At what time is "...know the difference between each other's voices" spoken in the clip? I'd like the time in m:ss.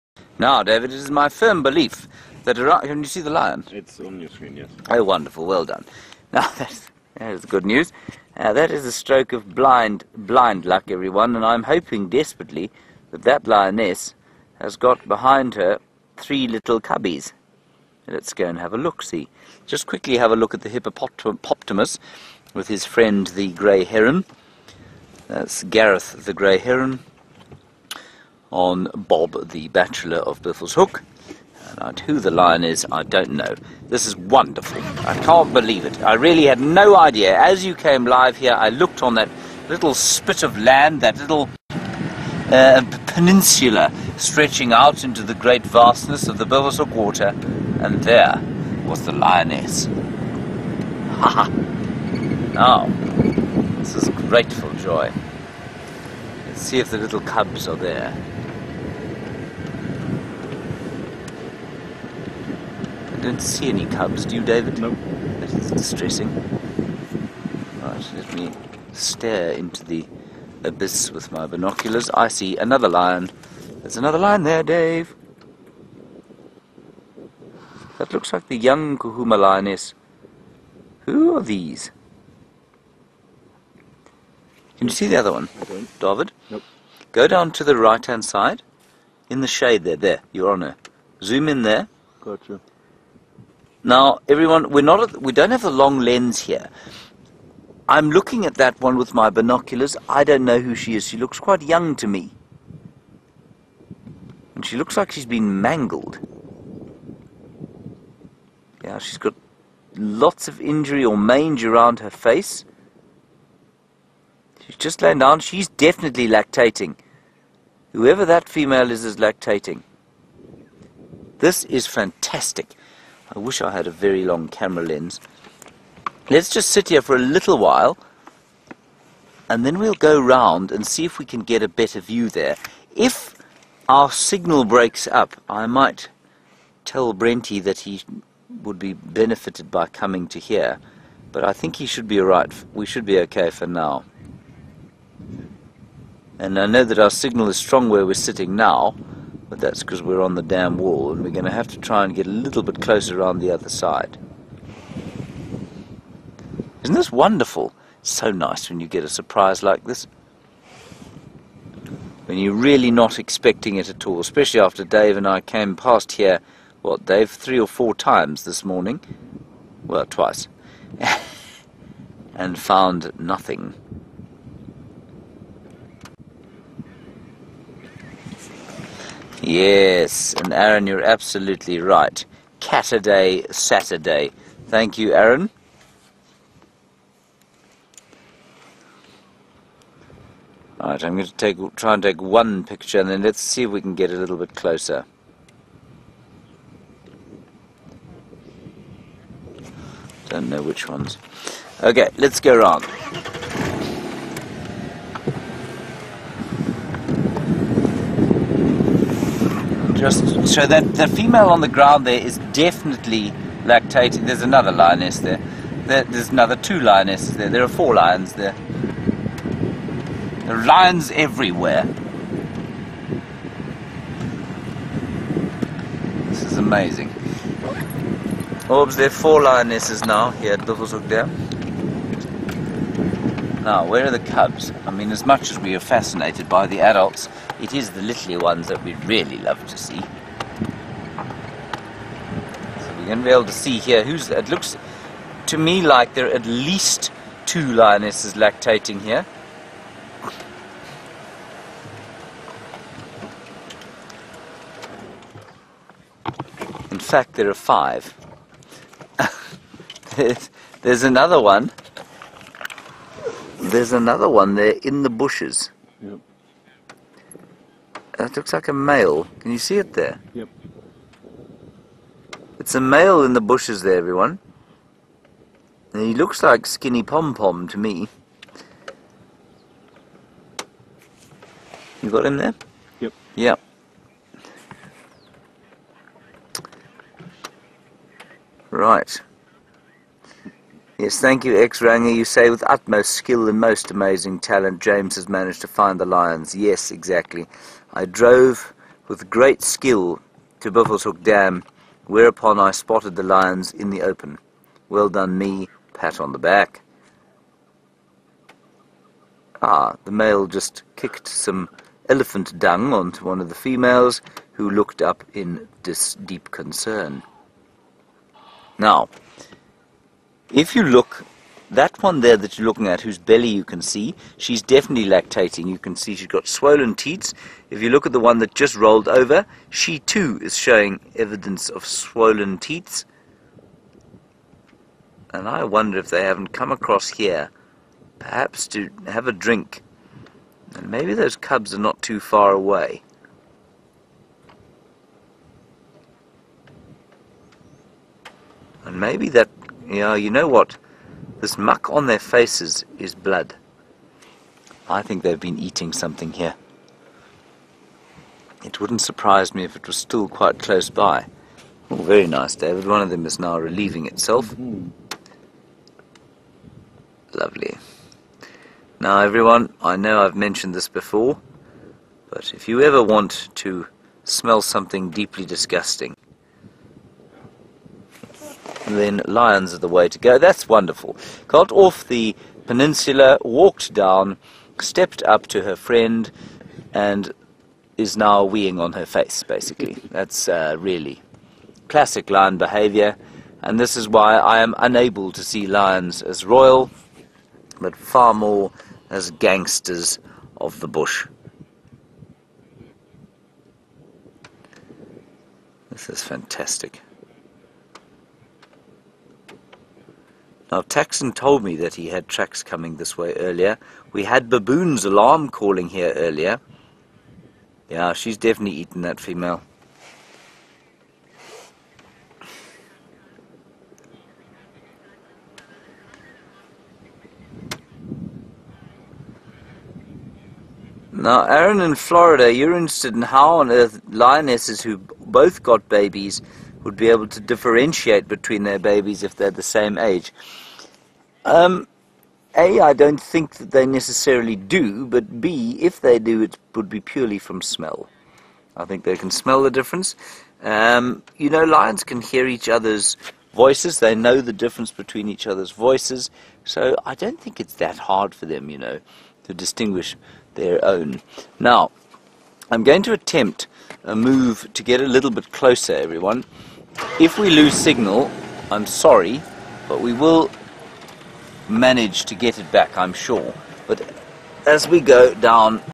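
7:34.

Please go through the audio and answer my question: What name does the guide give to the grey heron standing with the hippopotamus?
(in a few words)
Gareth.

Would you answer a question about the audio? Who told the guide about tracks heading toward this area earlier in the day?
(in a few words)
Taxon.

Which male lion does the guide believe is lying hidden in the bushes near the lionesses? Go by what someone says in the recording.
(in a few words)
Skinny Pom Pom.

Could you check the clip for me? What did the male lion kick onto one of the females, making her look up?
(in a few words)
Elephant dung.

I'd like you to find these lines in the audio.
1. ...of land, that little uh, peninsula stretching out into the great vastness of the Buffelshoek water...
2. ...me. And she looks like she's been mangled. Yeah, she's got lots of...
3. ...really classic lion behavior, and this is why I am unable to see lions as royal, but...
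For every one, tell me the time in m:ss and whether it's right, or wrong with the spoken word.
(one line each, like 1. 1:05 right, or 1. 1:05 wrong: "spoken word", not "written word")
1. 0:40 right
2. 1:42 right
3. 6:30 right.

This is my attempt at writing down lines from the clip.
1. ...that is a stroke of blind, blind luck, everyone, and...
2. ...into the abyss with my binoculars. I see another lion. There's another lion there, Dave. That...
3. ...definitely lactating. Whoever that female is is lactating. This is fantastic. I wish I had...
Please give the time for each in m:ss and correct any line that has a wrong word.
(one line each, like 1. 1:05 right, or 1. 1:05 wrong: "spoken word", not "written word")
1. 0:08 right
2. 1:09 right
3. 1:55 right.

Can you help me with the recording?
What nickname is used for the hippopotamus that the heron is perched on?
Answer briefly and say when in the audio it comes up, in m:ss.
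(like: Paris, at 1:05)
Bob the Bachelor, at 0:28.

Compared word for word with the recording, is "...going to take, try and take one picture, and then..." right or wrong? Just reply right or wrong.
right.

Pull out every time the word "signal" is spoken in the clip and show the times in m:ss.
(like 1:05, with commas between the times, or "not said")
2:14, 2:27, 7:47.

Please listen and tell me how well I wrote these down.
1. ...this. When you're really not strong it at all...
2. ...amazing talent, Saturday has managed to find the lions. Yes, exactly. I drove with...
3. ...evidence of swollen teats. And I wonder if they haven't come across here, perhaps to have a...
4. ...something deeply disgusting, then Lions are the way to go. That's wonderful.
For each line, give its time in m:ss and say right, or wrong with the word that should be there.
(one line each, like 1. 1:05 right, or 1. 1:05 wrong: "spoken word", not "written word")
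1. 2:39 wrong: "expecting", not "strong"
2. 4:53 wrong: "James", not "Saturday"
3. 5:31 right
4. 6:14 right.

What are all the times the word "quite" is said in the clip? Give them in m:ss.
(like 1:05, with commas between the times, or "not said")
1:41, 6:00.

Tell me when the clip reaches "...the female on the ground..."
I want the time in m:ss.
3:30.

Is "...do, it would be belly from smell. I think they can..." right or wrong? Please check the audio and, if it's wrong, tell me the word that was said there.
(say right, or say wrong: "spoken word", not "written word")
wrong: "purely", not "belly".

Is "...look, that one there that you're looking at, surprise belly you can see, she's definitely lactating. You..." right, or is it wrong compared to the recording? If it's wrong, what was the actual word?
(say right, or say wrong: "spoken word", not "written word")
wrong: "whose", not "surprise".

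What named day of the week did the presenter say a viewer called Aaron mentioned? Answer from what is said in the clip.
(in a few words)
Cataday Saturday.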